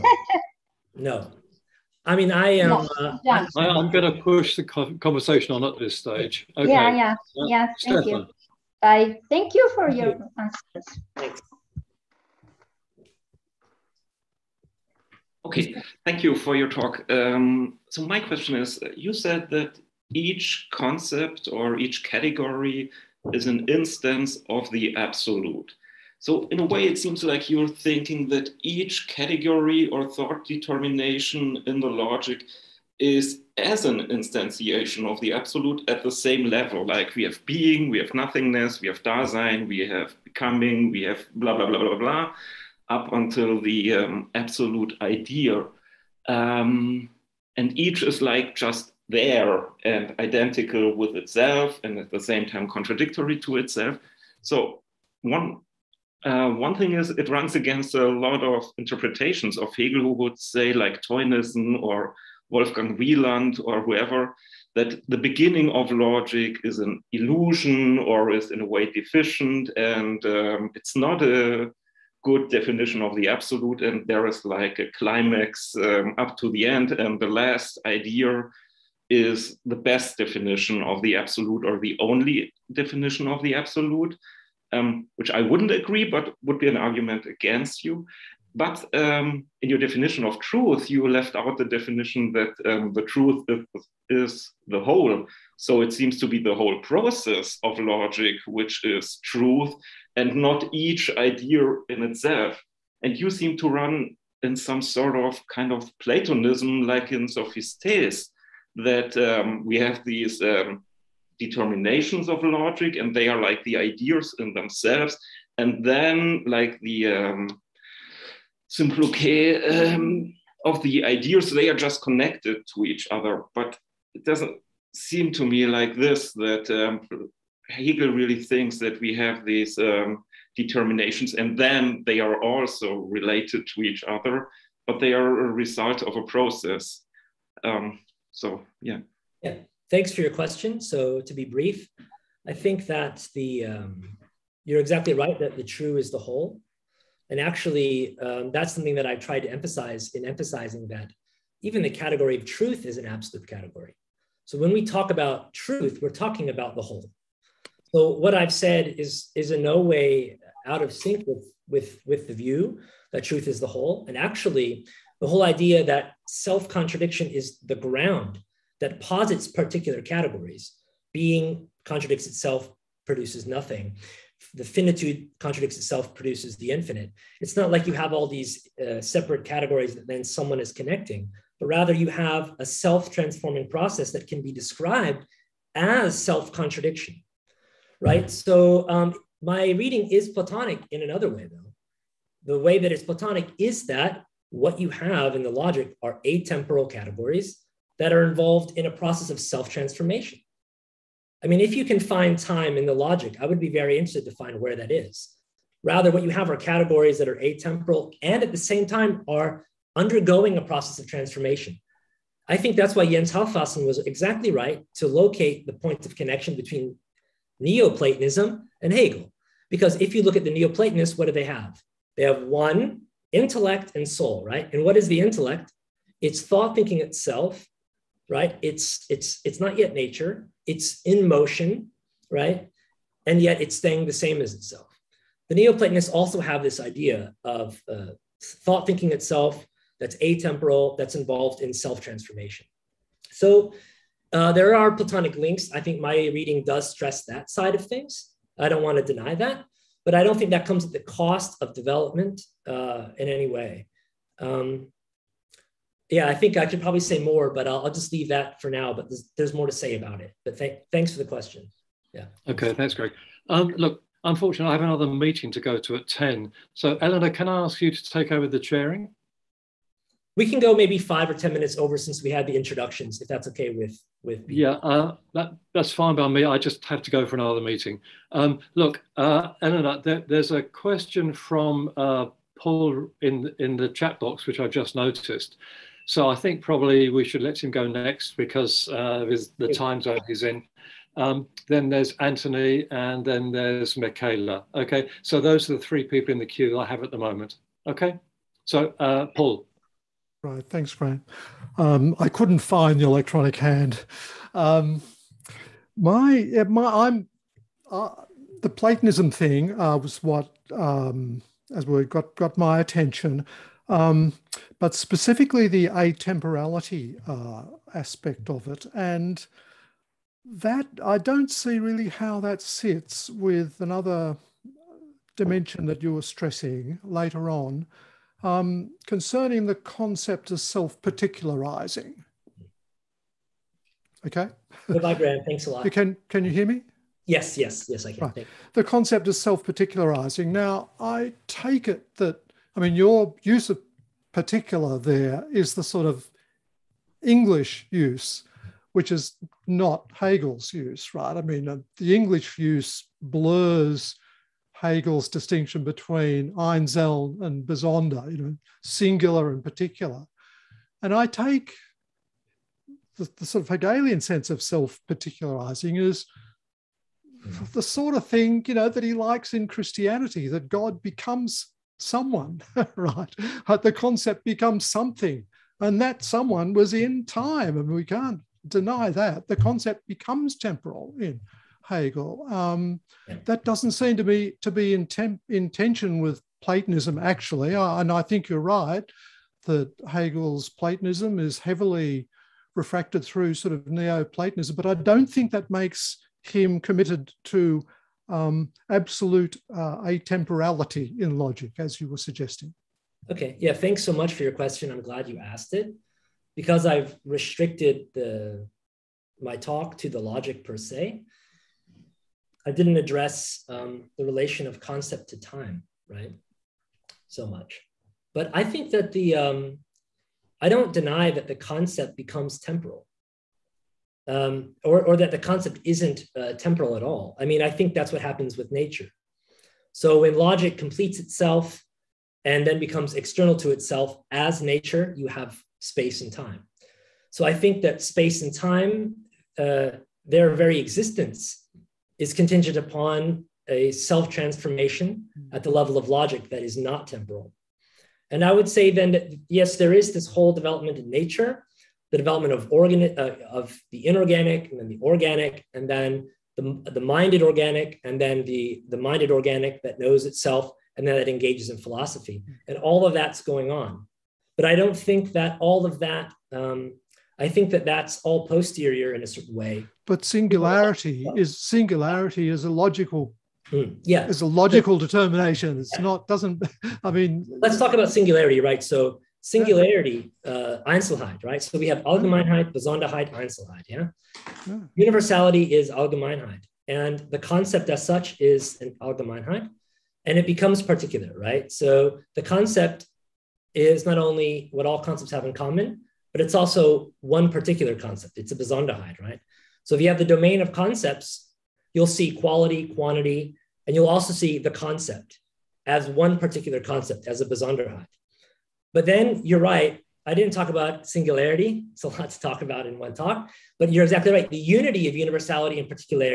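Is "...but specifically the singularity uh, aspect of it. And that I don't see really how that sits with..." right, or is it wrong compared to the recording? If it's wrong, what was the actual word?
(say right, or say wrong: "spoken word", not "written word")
wrong: "atemporality", not "singularity".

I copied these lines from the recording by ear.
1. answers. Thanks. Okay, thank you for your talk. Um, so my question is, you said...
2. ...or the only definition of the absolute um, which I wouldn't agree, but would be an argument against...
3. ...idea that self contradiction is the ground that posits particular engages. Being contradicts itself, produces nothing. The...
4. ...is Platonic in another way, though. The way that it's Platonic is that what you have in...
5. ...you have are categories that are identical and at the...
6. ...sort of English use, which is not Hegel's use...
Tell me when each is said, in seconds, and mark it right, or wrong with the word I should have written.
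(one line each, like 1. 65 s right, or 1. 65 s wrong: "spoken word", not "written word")
1. 10 s right
2. 81 s right
3. 165 s wrong: "categories", not "engages"
4. 190 s right
5. 206 s wrong: "atemporal", not "identical"
6. 345 s right.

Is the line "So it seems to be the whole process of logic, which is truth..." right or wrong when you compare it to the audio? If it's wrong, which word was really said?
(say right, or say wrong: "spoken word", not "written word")
right.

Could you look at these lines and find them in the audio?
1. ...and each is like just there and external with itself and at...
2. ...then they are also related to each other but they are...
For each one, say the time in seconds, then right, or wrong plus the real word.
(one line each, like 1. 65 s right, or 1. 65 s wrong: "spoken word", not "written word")
1. 47 s wrong: "identical", not "external"
2. 131 s right.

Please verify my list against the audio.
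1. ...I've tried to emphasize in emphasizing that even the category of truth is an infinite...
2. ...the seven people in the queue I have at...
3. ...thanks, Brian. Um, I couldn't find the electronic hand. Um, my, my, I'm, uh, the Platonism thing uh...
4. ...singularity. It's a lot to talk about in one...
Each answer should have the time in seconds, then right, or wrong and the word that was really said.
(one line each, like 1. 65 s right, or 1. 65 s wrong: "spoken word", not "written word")
1. 149 s wrong: "absolute", not "infinite"
2. 295 s wrong: "three", not "seven"
3. 300 s right
4. 511 s right.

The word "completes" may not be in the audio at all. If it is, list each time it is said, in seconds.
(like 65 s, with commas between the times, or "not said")
430 s.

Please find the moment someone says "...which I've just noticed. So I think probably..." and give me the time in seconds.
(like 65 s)
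284 s.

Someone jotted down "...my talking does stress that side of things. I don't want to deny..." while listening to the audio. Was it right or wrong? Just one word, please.
wrong.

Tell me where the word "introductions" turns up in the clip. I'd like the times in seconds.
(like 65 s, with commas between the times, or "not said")
272 s.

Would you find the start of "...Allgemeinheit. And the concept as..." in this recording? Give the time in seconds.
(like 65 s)
485 s.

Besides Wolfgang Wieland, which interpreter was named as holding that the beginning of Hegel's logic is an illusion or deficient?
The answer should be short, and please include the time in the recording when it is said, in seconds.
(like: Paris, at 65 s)
Theunissen, at 61 s.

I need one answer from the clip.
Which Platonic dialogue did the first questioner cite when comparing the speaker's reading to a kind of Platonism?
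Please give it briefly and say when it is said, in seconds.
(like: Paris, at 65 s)
Sophistes, at 107 s.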